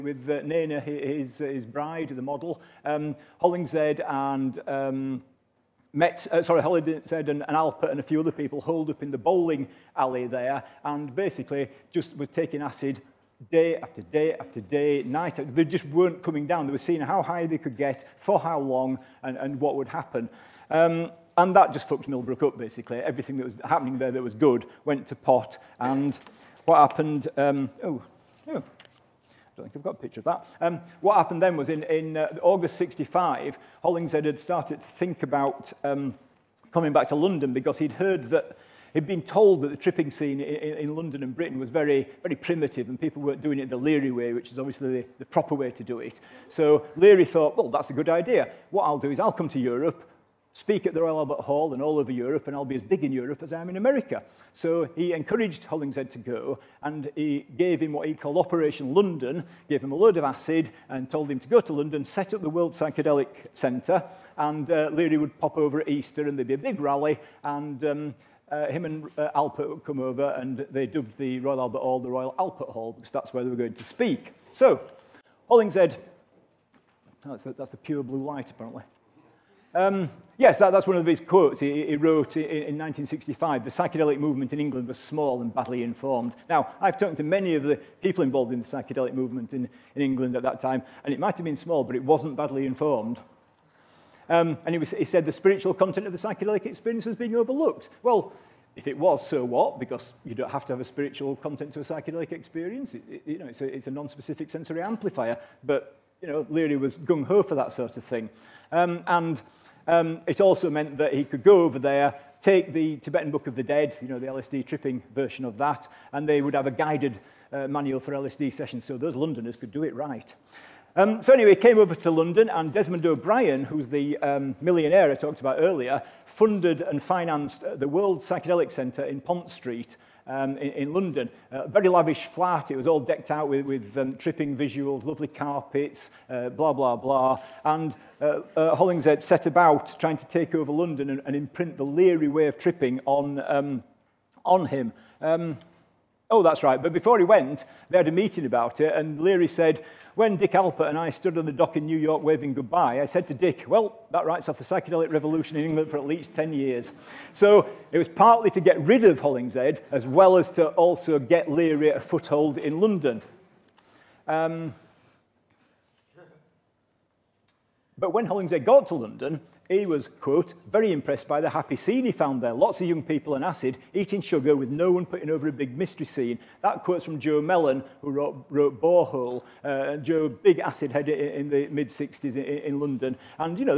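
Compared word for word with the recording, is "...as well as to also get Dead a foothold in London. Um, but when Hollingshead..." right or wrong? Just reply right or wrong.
wrong.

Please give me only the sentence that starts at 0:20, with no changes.
Um, and that just fucked Millbrook up, basically.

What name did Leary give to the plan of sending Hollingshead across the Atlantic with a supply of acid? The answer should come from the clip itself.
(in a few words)
Operation London.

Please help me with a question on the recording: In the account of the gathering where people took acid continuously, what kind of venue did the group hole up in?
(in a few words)
Bowling alley.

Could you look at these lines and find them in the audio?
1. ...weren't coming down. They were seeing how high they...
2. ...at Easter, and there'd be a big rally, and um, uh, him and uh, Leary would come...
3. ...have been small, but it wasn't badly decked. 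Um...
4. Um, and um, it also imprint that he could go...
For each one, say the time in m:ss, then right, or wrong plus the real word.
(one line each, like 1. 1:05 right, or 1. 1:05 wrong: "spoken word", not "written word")
1. 0:15 right
2. 1:05 wrong: "Alpert", not "Leary"
3. 1:31 wrong: "informed", not "decked"
4. 1:48 wrong: "meant", not "imprint".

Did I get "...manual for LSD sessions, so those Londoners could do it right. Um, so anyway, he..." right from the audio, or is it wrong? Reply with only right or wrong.
right.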